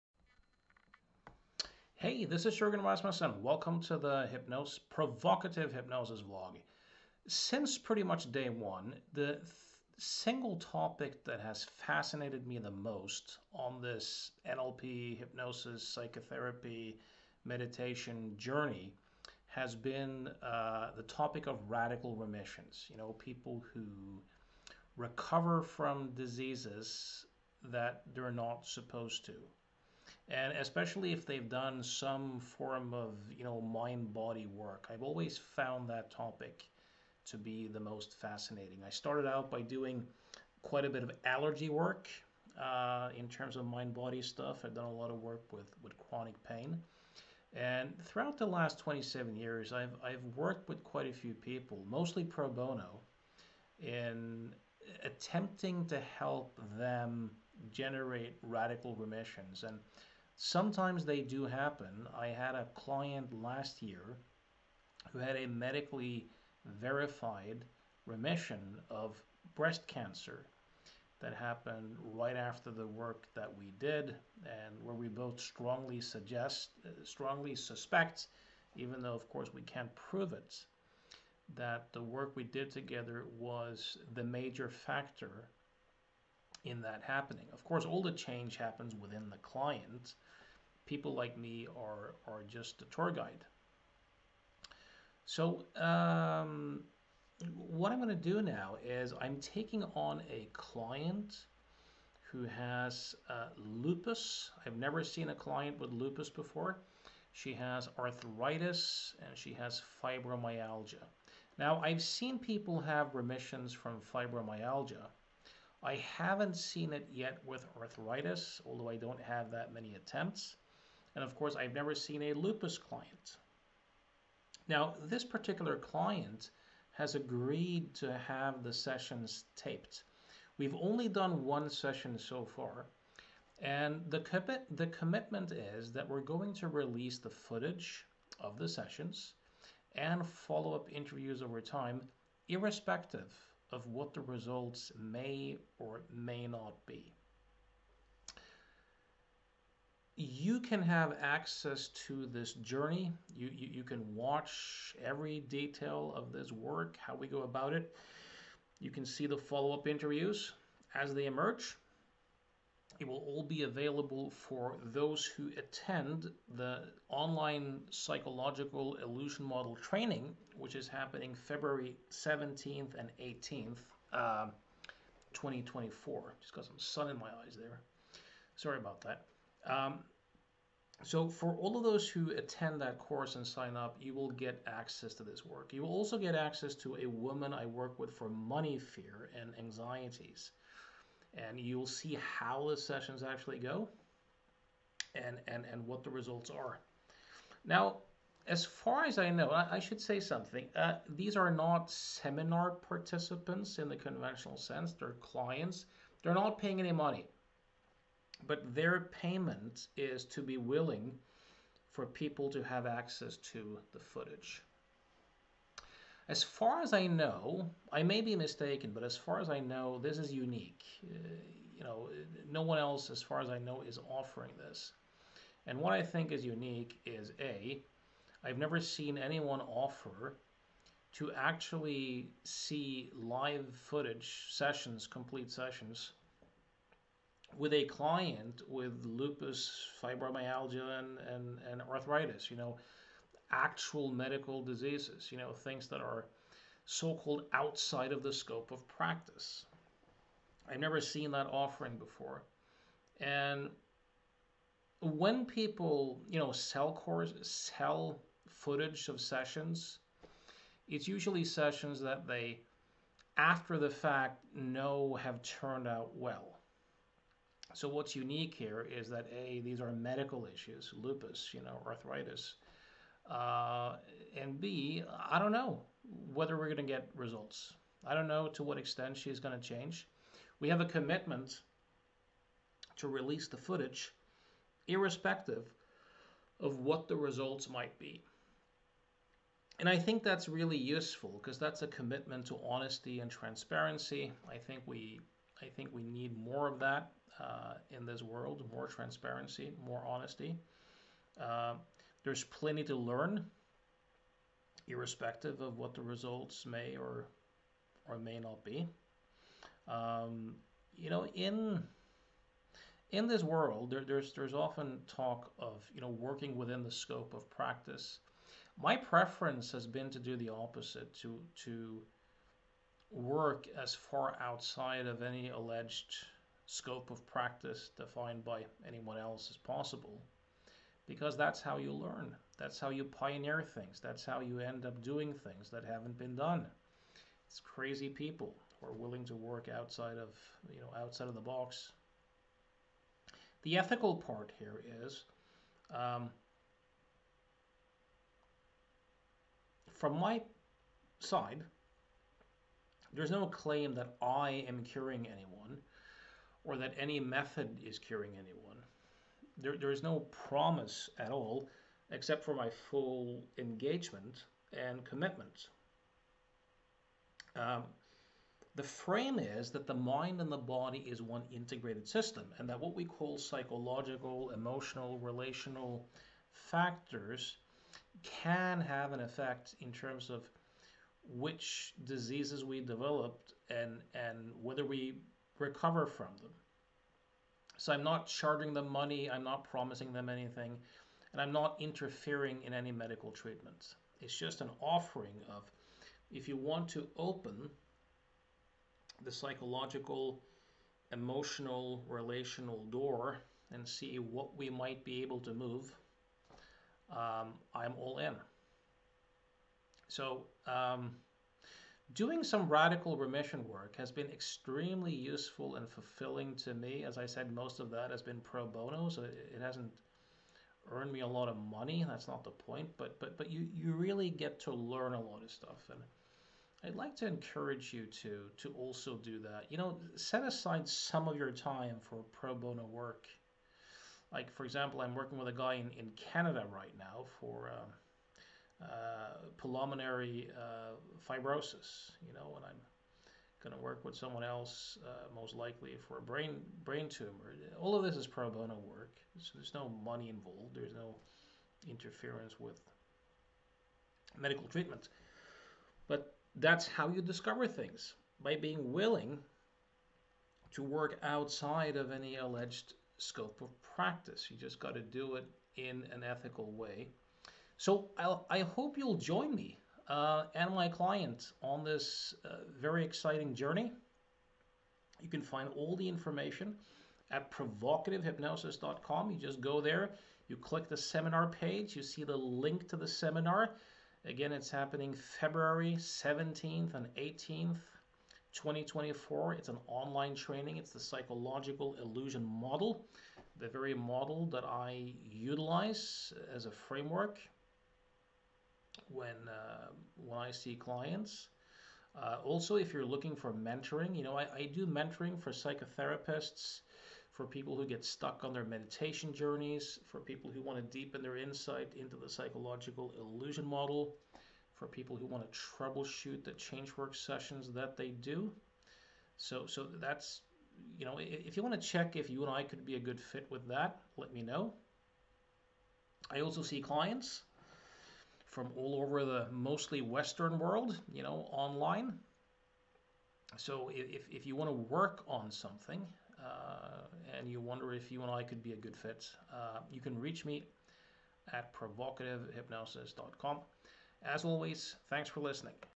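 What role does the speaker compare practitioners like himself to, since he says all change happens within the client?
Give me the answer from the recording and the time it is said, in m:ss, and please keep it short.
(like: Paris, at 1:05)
a tour guide, at 1:32.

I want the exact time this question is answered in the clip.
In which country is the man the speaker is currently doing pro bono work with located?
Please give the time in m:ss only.
7:16.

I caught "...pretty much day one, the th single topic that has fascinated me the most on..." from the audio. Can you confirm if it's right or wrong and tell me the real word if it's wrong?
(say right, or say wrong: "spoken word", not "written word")
right.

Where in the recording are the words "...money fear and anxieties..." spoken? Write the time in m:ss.
3:08.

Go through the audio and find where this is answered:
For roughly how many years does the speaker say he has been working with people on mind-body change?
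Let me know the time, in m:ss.
0:48.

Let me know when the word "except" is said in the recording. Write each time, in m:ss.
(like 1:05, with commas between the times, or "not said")
6:02.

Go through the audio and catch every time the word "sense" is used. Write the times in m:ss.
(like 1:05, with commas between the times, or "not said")
3:24.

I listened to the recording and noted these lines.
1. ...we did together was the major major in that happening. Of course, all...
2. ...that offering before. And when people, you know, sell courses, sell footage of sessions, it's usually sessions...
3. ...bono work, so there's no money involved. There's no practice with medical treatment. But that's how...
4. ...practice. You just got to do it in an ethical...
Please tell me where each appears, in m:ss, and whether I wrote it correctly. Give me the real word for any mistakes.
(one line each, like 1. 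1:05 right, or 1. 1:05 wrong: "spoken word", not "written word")
1. 1:22 wrong: "factor", not "major"
2. 4:11 right
3. 7:28 wrong: "interference", not "practice"
4. 7:43 right.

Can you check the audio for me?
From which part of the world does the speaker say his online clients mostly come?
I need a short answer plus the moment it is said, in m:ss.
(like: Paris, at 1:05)
Western world, at 8:50.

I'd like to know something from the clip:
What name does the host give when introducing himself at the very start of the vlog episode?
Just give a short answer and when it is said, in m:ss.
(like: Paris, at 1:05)
Jurgen Rasmussen, at 0:02.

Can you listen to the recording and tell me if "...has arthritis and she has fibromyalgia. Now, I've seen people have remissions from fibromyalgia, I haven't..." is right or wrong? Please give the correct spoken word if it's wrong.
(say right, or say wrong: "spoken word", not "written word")
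right.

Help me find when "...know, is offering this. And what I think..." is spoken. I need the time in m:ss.
3:43.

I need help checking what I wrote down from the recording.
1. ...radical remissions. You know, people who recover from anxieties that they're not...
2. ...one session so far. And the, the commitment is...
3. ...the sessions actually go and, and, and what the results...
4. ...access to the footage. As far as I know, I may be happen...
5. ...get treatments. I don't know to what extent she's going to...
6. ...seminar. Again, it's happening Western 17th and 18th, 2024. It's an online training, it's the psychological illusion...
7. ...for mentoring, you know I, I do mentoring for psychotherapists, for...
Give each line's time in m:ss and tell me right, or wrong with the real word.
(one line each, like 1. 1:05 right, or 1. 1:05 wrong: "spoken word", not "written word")
1. 0:21 wrong: "diseases", not "anxieties"
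2. 2:11 right
3. 3:12 right
4. 3:32 wrong: "mistaken", not "happen"
5. 4:36 wrong: "results", not "treatments"
6. 8:03 wrong: "February", not "Western"
7. 8:23 right.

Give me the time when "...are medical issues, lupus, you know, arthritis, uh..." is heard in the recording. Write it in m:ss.
4:29.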